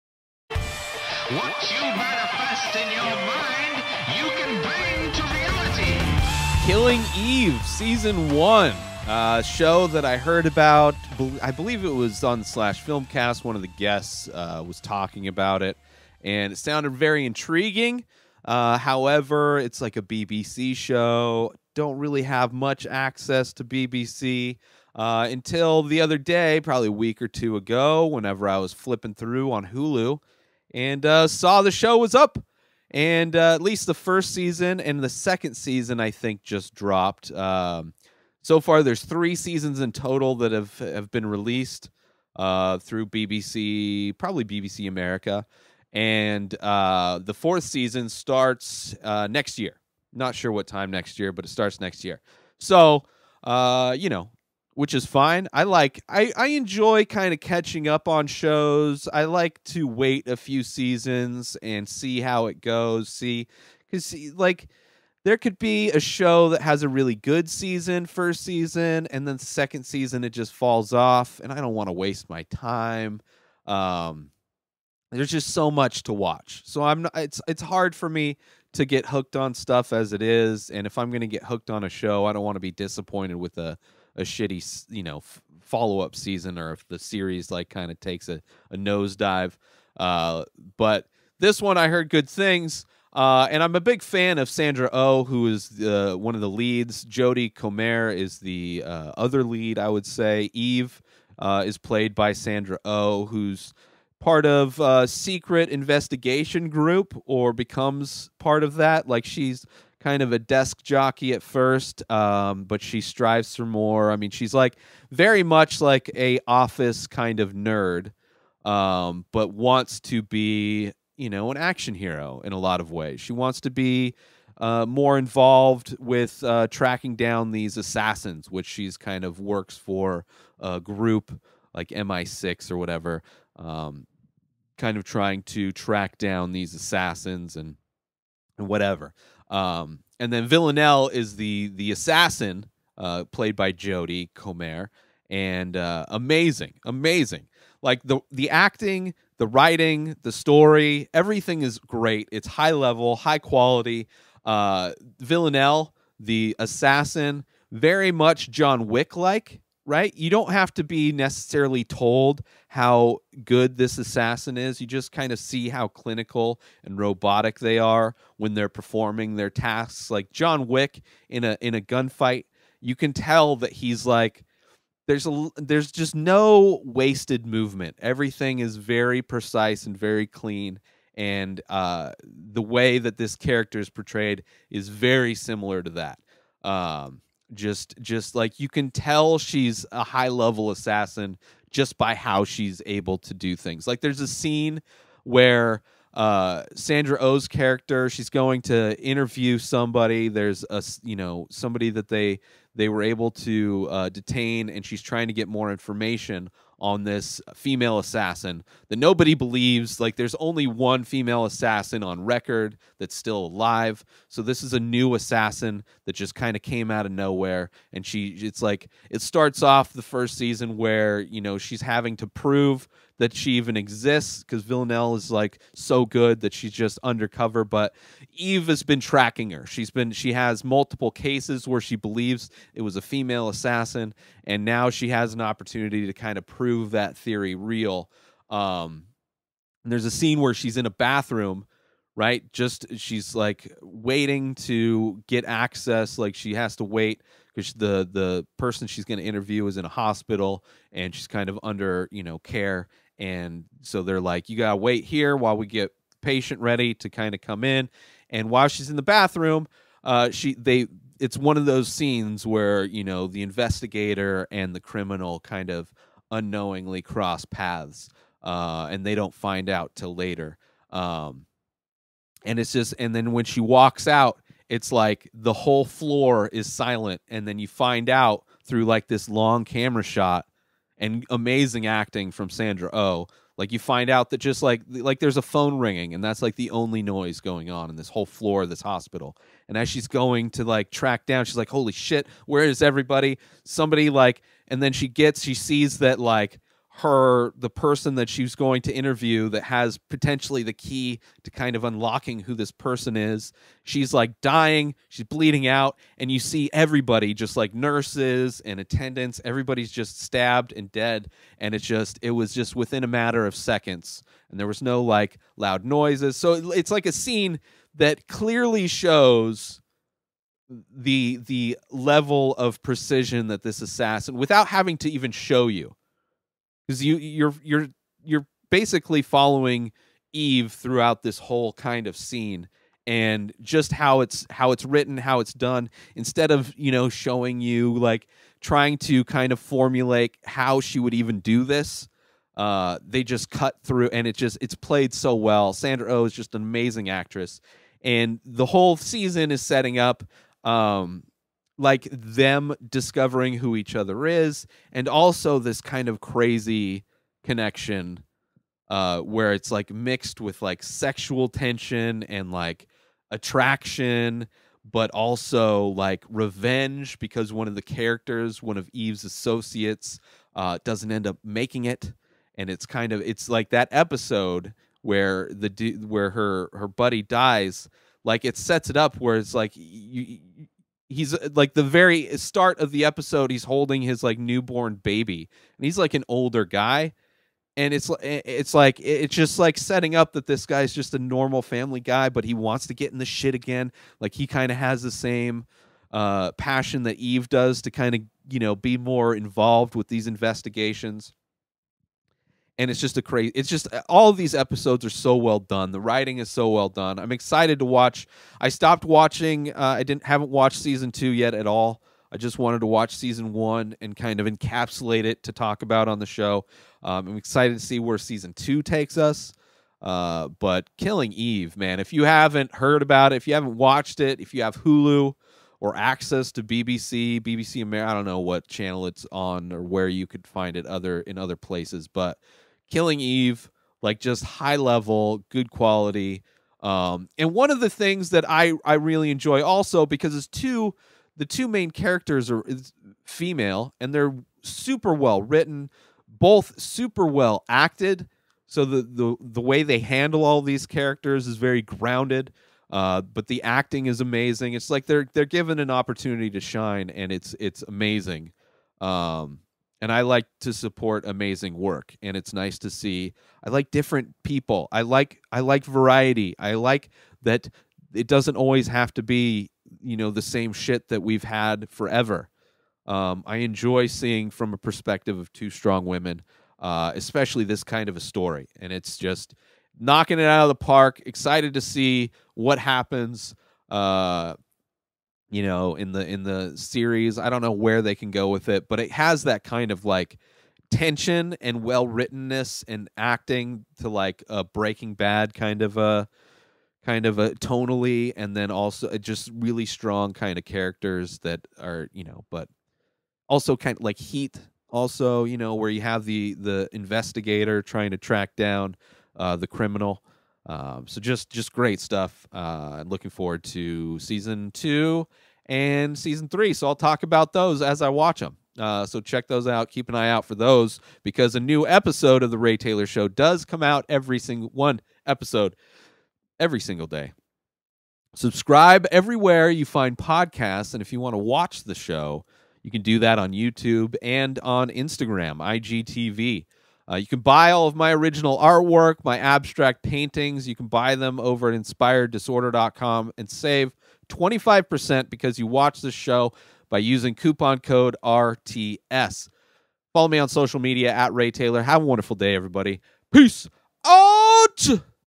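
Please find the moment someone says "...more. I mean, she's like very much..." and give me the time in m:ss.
1:53.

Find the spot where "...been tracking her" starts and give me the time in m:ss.
3:48.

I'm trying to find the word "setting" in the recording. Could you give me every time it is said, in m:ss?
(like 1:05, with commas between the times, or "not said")
5:49, 6:29.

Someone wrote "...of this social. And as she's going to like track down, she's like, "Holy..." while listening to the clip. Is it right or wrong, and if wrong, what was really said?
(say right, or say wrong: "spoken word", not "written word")
wrong: "hospital", not "social".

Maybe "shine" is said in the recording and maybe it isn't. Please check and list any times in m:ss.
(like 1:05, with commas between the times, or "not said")
7:36.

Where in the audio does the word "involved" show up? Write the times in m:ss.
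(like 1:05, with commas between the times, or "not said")
2:05, 6:39.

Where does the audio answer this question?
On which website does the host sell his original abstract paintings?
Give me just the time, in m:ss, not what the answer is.
9:01.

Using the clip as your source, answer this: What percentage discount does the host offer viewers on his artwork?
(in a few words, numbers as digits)
25%.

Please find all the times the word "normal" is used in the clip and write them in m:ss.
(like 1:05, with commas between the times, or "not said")
6:31.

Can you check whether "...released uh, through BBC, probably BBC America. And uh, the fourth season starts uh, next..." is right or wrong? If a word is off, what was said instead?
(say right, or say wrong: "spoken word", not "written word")
right.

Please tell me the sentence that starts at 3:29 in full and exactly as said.
Like there's only one female assassin on record that's still alive.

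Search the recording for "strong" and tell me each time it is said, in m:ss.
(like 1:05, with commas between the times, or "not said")
7:55, 8:19.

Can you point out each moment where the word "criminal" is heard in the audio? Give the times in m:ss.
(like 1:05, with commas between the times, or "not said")
4:24, 8:29.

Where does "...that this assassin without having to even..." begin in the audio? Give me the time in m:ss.
5:23.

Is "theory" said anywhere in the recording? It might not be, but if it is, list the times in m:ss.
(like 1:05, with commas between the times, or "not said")
3:57.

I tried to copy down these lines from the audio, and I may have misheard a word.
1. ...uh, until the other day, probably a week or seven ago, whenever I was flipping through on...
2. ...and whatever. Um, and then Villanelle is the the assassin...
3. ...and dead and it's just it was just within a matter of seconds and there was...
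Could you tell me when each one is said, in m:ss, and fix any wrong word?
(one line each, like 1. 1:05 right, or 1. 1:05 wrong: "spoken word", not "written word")
1. 0:24 wrong: "two", not "seven"
2. 2:18 right
3. 5:10 right.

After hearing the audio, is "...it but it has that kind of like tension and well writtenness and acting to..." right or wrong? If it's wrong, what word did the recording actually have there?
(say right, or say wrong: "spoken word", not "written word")
right.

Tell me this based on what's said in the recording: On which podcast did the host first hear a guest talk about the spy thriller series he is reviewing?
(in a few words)
Slash Filmcast.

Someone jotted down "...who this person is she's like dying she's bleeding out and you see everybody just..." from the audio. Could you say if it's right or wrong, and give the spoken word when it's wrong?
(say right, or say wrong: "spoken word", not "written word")
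right.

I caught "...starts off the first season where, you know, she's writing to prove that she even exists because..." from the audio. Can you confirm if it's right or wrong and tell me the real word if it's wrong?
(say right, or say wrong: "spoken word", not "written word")
wrong: "having", not "writing".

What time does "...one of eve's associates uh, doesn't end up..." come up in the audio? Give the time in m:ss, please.
6:08.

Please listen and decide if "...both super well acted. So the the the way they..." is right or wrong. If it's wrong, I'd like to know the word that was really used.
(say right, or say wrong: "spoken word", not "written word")
right.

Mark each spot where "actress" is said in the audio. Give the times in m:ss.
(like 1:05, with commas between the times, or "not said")
5:47.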